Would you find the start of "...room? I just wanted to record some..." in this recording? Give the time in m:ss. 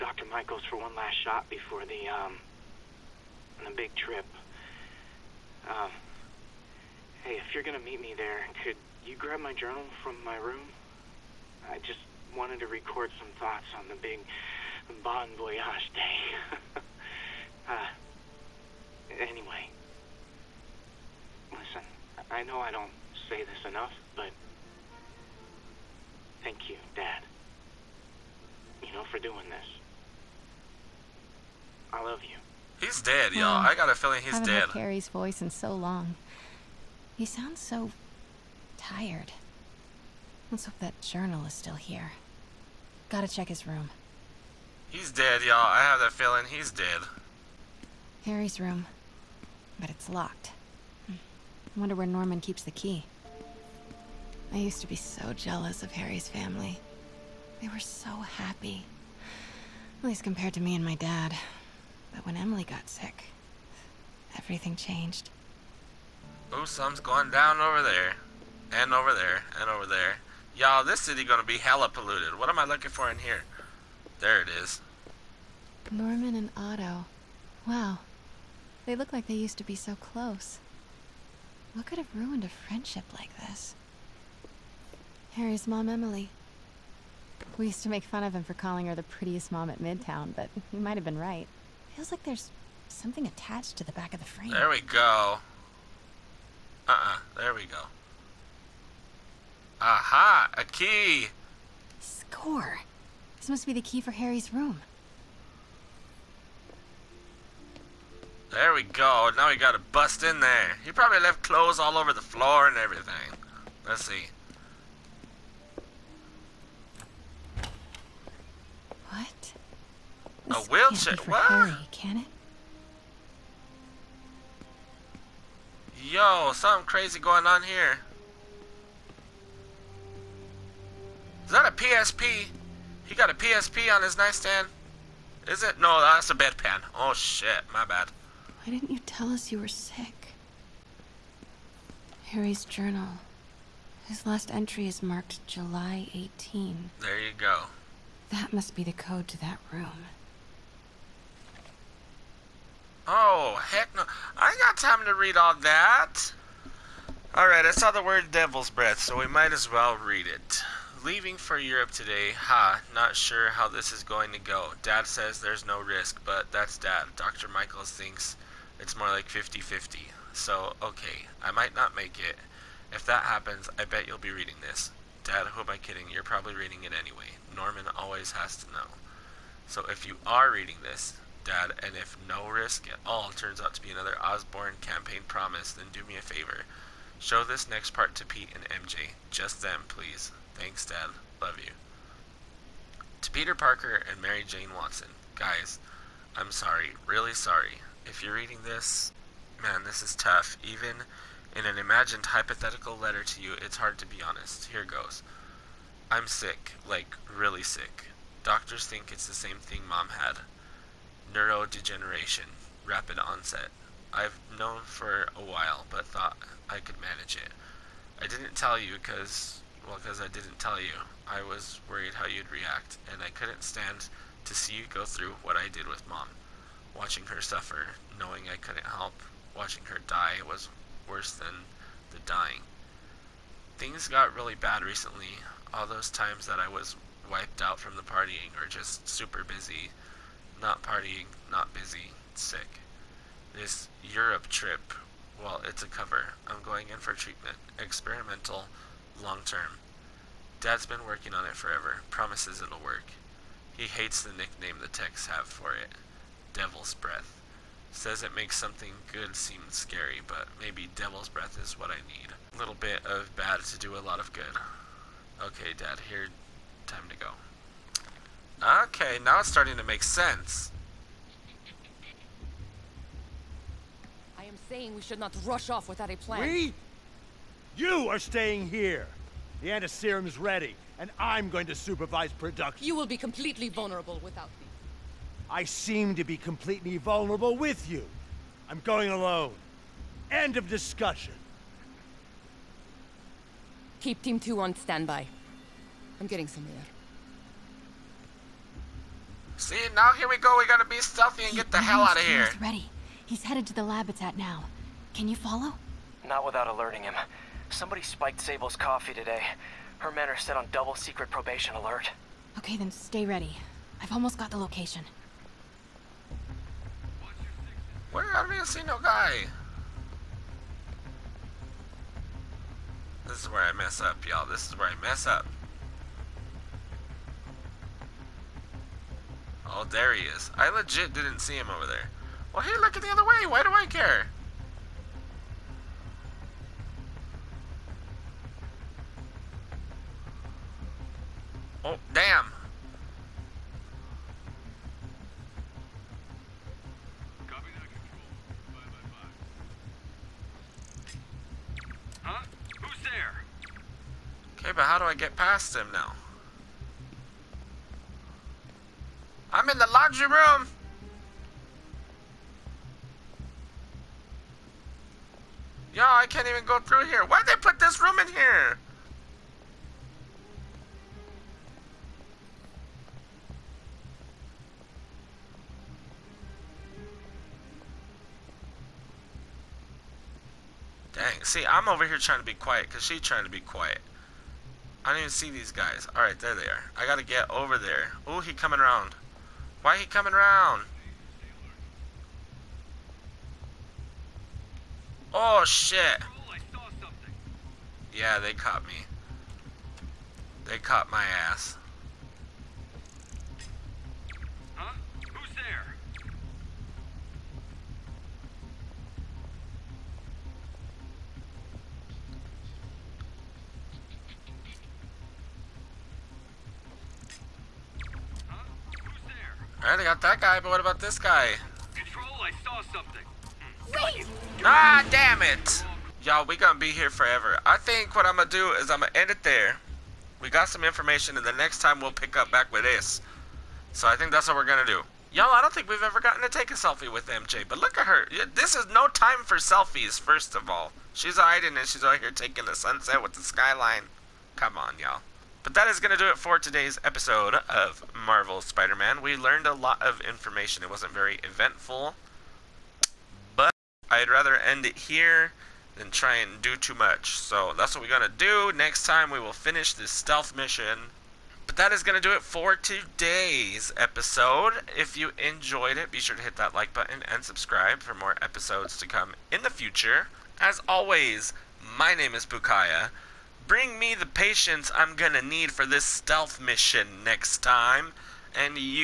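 0:10.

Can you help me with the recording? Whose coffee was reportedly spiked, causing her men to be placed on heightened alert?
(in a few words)
Sable.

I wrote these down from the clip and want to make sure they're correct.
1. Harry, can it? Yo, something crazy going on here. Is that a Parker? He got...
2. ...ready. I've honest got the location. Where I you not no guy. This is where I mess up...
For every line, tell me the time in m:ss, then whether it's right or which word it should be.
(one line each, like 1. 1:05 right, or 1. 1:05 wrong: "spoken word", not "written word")
1. 2:01 wrong: "PSP", not "Parker"
2. 5:13 wrong: "almost", not "honest".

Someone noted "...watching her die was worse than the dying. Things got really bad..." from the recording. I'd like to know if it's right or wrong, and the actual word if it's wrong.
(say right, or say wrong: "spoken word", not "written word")
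right.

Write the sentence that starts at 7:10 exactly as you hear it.
We got some information, and the next time we'll pick up back with this.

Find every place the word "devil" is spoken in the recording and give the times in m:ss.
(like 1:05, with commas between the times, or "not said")
2:38, 4:16, 4:20.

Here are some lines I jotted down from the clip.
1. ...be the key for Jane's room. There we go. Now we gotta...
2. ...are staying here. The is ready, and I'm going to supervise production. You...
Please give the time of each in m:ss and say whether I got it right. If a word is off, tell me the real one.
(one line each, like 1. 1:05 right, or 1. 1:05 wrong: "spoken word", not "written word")
1. 1:43 wrong: "Harry", not "Jane"
2. 4:38 right.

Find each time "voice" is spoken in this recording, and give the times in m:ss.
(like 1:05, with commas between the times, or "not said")
0:35.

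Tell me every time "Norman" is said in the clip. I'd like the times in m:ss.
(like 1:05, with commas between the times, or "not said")
0:52, 1:15, 2:57.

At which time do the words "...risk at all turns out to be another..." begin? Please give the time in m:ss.
3:02.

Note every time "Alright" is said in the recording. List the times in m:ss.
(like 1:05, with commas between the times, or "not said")
2:37, 6:26, 6:59.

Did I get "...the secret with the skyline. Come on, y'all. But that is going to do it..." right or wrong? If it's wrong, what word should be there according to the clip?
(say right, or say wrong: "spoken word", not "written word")
wrong: "sunset", not "secret".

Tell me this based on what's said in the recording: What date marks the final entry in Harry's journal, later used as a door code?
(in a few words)
July 18.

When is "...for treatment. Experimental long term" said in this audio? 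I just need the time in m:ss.
4:06.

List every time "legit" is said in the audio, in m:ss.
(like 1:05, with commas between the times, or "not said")
5:30.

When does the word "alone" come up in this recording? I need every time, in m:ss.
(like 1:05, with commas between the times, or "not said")
4:49.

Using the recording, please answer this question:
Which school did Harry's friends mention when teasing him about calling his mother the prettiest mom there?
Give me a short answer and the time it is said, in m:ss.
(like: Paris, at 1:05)
Midtown, at 1:29.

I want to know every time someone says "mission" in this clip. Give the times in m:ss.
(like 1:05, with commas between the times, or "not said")
7:40, 7:56.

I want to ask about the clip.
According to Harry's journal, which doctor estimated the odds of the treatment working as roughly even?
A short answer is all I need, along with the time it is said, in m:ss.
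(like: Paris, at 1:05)
Dr. Michaels, at 2:47.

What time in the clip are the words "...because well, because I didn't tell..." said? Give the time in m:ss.
3:38.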